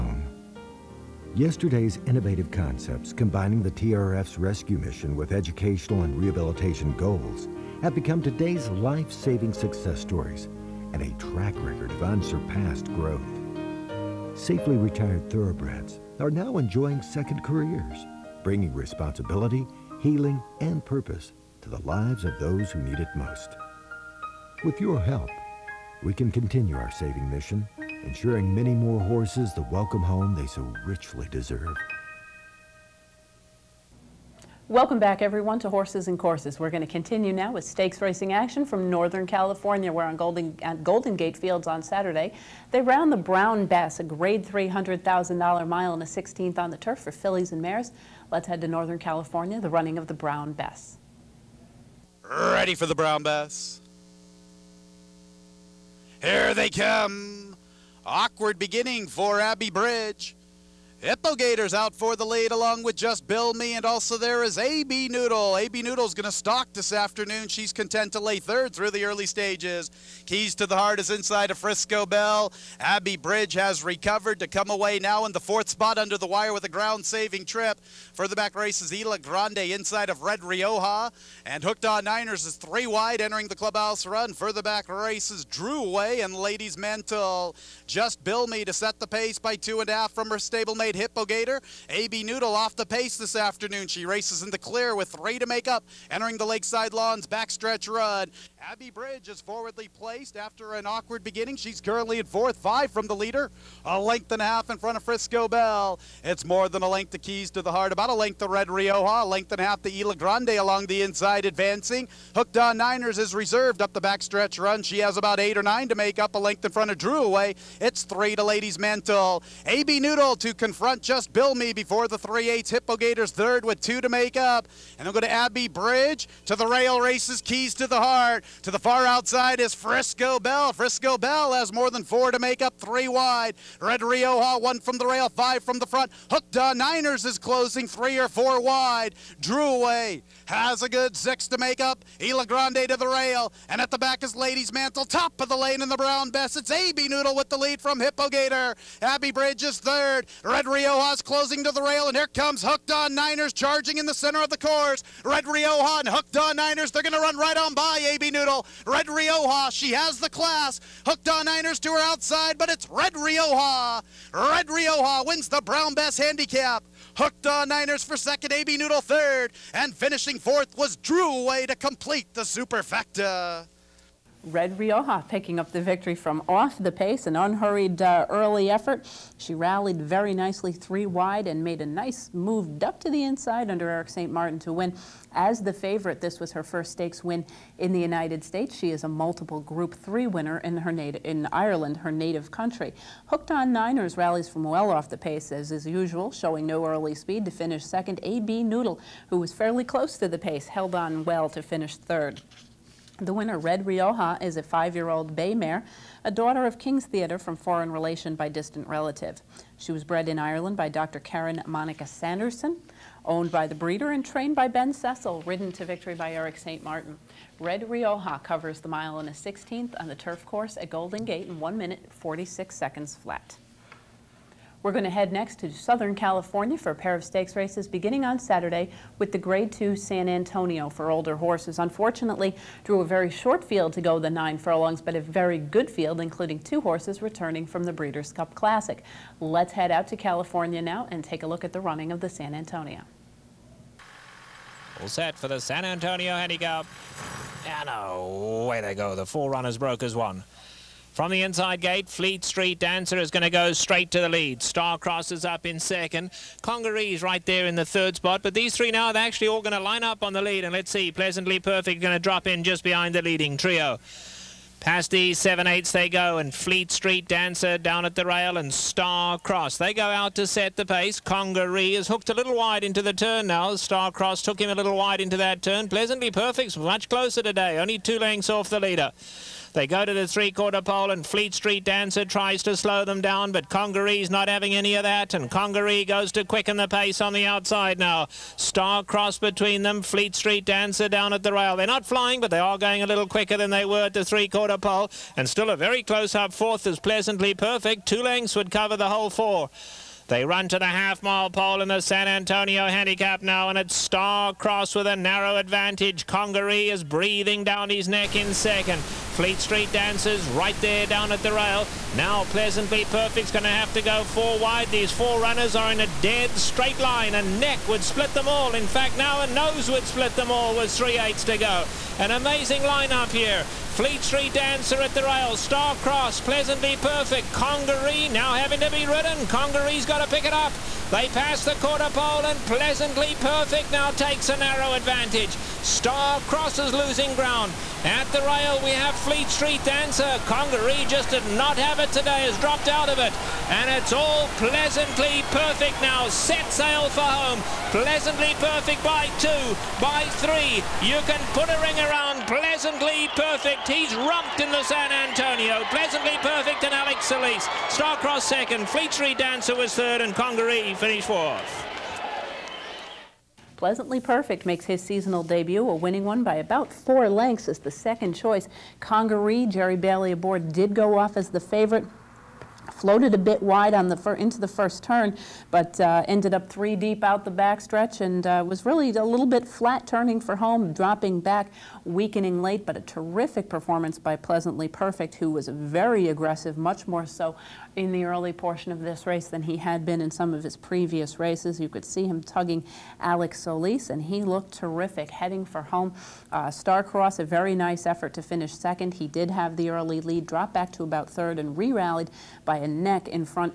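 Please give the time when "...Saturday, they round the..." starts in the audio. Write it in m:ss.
0:41.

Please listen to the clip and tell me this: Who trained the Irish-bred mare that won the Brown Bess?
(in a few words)
Ben Cecil.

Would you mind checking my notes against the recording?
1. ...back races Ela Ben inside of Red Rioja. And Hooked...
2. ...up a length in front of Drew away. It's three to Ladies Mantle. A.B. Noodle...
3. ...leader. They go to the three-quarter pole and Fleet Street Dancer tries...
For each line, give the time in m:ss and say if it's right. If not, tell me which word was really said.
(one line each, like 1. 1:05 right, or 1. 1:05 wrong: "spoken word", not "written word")
1. 1:18 wrong: "Grande", not "Ben"
2. 1:56 right
3. 4:38 right.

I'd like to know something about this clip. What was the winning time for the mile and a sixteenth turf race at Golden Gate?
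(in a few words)
1 minute 46 seconds.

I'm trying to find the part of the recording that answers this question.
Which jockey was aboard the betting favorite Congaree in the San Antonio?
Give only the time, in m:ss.
6:09.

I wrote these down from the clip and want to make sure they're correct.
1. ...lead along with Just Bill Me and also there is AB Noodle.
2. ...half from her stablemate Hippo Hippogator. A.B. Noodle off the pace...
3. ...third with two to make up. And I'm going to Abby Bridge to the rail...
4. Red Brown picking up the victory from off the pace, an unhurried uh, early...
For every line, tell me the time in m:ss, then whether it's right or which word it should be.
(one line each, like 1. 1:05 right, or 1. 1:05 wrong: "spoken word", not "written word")
1. 1:02 right
2. 1:29 right
3. 2:03 right
4. 2:54 wrong: "Rioja", not "Brown".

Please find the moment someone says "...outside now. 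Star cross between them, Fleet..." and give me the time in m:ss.
4:47.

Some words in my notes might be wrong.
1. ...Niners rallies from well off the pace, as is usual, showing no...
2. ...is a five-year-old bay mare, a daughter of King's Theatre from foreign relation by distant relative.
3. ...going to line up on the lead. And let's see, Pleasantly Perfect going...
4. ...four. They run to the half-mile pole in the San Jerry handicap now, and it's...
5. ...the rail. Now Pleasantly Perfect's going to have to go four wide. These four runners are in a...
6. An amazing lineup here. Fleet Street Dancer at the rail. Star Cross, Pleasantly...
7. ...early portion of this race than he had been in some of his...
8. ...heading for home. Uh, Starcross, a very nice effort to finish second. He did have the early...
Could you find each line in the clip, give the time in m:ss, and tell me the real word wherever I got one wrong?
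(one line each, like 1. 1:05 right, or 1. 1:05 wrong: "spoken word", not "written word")
1. 3:13 right
2. 3:24 right
3. 4:19 right
4. 4:59 wrong: "Antonio", not "Jerry"
5. 5:11 right
6. 5:22 right
7. 6:28 right
8. 6:35 right.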